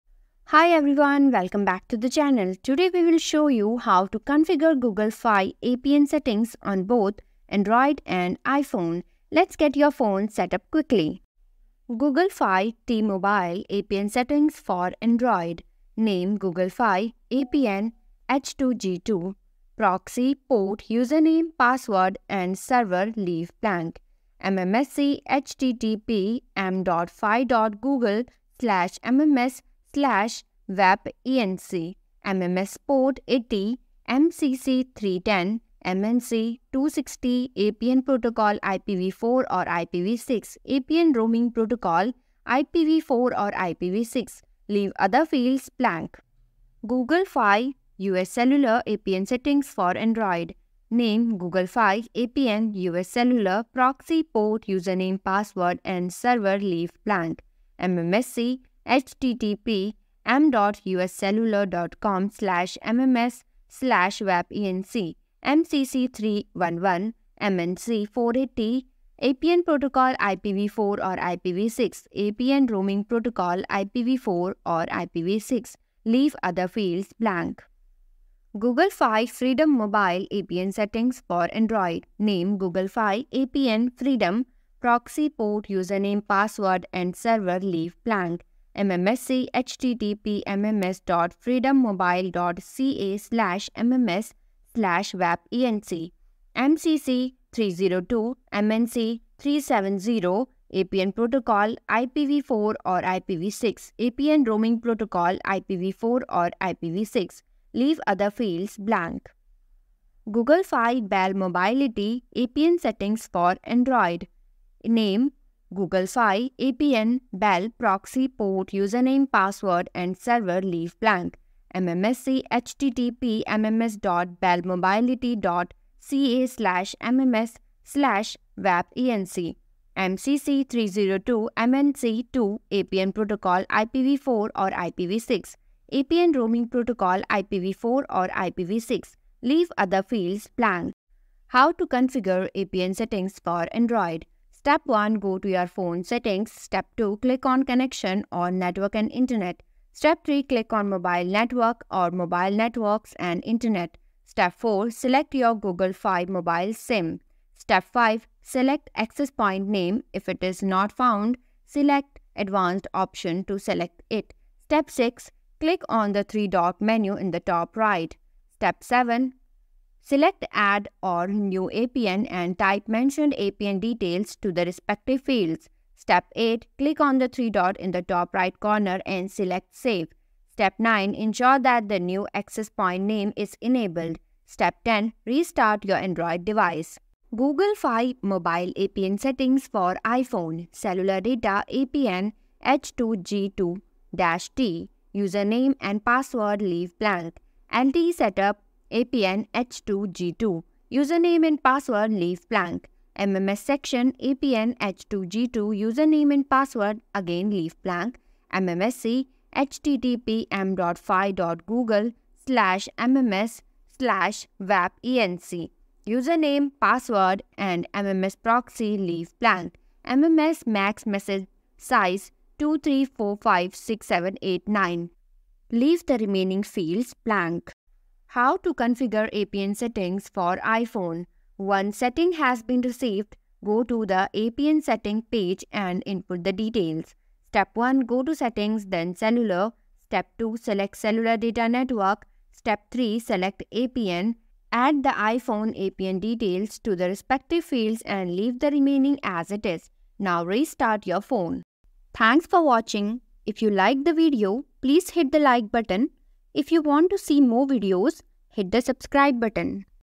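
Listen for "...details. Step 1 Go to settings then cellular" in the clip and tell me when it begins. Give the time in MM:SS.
03:56.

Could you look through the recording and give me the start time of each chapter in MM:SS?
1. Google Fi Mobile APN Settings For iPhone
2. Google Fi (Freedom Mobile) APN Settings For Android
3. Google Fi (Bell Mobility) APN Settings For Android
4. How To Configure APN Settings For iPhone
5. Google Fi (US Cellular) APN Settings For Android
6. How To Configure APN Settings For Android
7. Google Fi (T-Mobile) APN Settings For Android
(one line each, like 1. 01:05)
1. 03:07
2. 01:18
3. 01:49
4. 03:47
5. 00:46
6. 02:21
7. 00:11.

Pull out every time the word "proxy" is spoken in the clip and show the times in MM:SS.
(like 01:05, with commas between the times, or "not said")
00:19, 00:53, 01:24, 01:57, 03:38.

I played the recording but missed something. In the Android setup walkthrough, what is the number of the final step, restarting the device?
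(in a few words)
10.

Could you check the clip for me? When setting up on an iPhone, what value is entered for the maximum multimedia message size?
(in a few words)
23456789.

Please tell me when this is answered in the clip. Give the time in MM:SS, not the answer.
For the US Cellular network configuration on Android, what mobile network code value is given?
01:07.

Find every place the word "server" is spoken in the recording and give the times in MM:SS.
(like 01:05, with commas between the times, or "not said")
00:22, 00:56, 01:27, 02:00.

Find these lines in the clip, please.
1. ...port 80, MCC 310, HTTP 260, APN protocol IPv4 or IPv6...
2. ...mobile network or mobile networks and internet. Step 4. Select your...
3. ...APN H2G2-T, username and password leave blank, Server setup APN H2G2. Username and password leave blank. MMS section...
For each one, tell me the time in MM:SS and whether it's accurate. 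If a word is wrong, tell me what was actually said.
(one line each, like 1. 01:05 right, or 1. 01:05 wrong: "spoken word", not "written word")
1. 00:32 wrong: "MNC", not "HTTP"
2. 02:30 right
3. 03:11 wrong: "LTE", not "Server".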